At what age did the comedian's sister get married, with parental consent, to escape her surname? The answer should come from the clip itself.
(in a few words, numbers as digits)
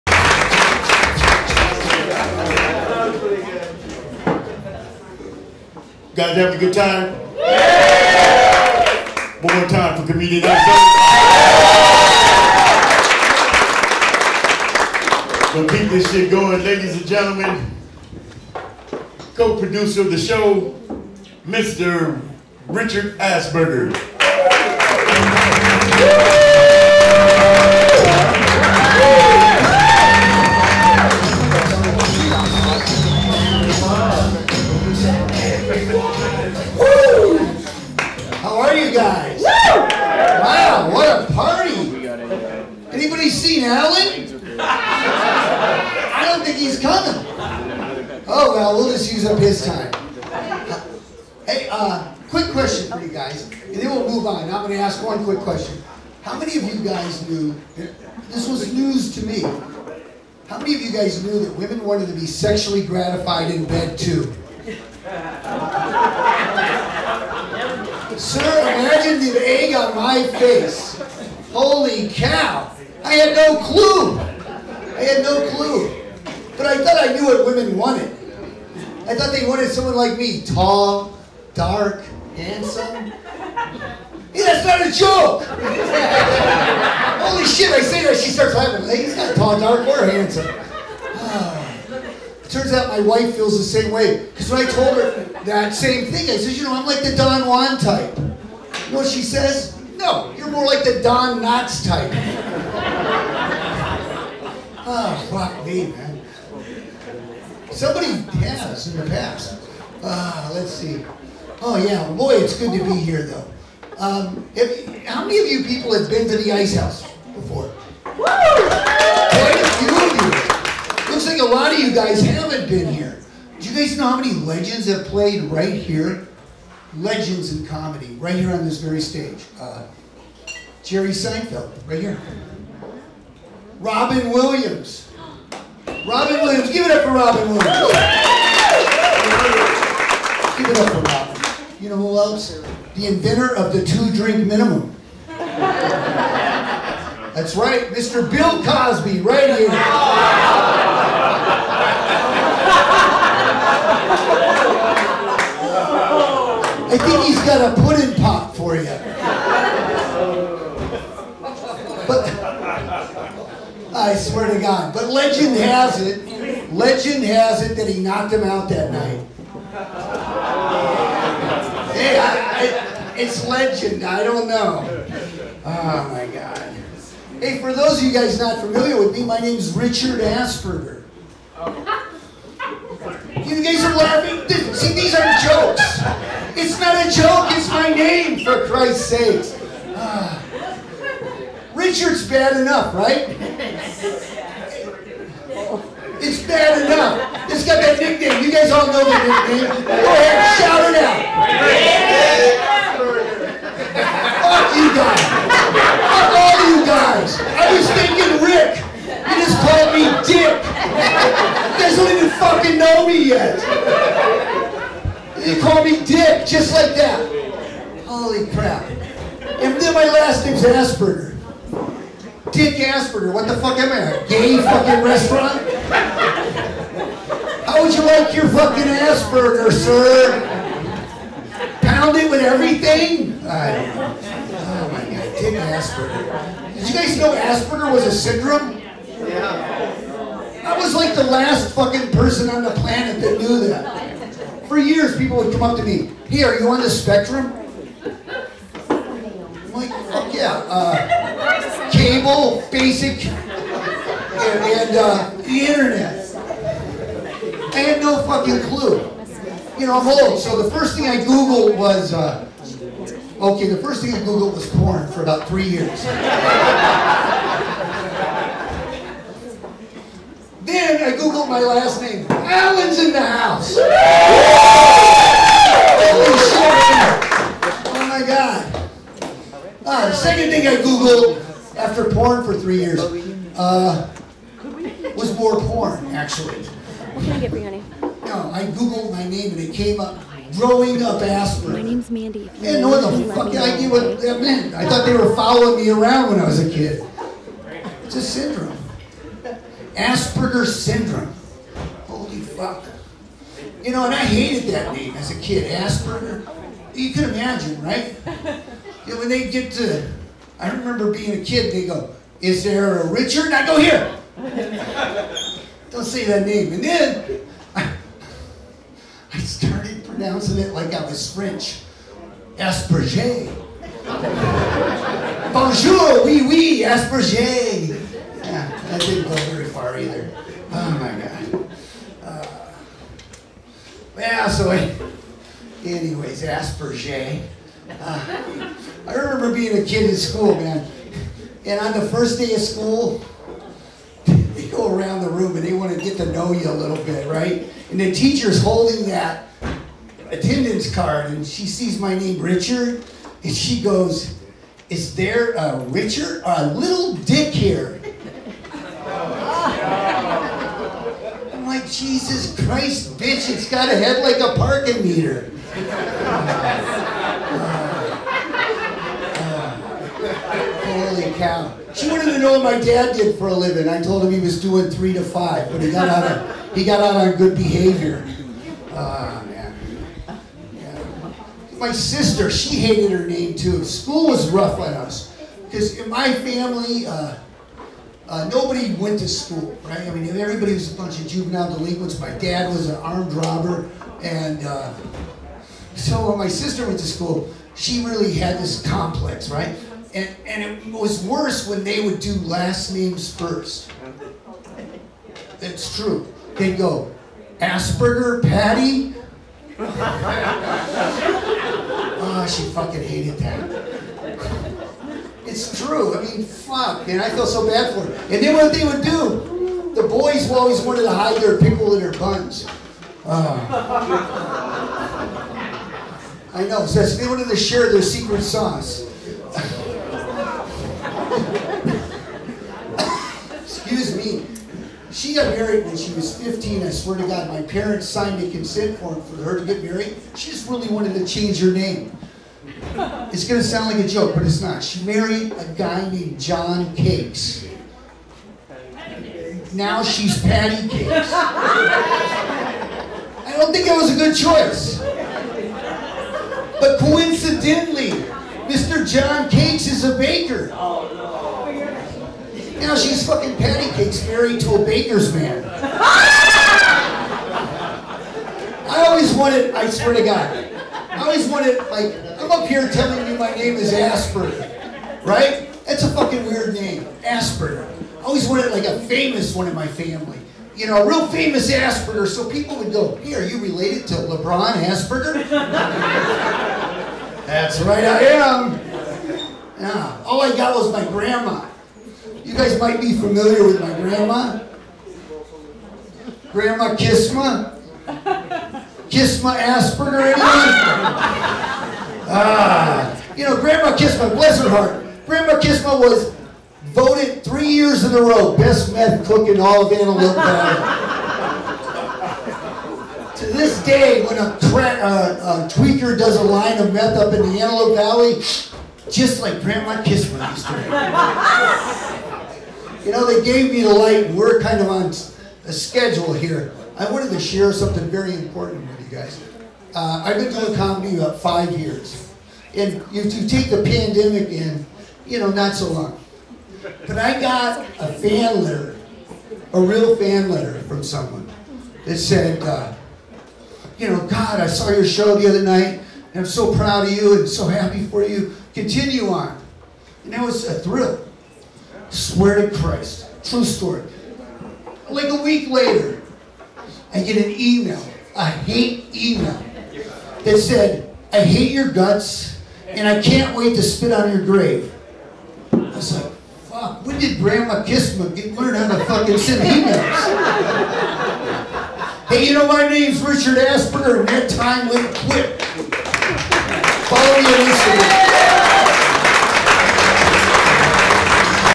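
15.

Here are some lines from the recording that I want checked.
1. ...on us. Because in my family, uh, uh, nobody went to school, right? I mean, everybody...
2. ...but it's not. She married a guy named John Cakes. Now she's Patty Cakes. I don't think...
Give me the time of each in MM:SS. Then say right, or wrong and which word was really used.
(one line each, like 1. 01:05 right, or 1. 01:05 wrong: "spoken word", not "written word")
1. 06:24 right
2. 07:24 right.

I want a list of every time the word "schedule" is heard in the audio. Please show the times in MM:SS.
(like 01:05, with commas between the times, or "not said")
08:45.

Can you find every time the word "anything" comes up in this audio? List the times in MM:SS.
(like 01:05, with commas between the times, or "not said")
04:40.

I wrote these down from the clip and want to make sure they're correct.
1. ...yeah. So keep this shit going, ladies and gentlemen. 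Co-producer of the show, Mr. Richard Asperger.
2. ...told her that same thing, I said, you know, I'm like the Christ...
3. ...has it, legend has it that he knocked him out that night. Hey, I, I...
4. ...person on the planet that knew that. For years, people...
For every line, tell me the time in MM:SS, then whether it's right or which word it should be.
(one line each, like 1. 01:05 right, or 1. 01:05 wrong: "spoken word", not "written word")
1. 00:10 right
2. 01:34 wrong: "Don", not "Christ"
3. 02:45 right
4. 04:02 right.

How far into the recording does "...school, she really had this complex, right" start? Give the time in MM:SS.
06:37.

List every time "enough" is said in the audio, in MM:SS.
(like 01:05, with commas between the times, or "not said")
03:12, 03:16.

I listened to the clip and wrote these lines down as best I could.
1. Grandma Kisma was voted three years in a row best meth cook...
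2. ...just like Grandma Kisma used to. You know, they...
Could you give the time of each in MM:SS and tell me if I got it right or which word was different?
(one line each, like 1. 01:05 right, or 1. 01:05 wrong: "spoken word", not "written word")
1. 08:25 right
2. 08:39 right.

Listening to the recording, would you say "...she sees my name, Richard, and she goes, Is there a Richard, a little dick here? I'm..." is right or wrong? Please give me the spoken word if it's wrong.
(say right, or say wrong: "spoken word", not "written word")
right.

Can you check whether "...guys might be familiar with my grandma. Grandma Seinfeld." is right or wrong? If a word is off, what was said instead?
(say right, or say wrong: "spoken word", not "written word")
wrong: "Kisma", not "Seinfeld".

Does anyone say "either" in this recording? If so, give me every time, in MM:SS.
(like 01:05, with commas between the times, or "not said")
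05:29.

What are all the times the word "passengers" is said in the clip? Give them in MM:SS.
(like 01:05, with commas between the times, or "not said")
not said.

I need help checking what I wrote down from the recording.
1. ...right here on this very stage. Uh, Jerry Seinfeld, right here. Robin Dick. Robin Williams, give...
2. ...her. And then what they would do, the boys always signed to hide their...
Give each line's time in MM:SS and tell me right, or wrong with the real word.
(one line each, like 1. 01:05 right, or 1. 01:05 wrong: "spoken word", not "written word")
1. 02:08 wrong: "Williams", not "Dick"
2. 06:58 wrong: "wanted", not "signed".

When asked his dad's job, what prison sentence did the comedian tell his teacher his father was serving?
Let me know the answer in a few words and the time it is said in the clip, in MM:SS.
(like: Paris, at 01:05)
3 to 5, at 06:14.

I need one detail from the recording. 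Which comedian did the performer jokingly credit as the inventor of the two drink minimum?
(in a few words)
Bill Cosby.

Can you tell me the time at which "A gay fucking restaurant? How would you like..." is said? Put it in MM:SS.
03:44.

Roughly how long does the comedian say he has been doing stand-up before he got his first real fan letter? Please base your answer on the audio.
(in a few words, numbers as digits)
5 years.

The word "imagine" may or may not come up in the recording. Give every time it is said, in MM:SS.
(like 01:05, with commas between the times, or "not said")
01:08, 05:07.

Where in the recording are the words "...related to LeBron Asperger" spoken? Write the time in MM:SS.
08:03.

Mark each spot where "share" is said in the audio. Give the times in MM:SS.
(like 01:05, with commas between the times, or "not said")
07:07, 08:47.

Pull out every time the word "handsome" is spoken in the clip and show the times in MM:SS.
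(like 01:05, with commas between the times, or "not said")
01:22, 01:30.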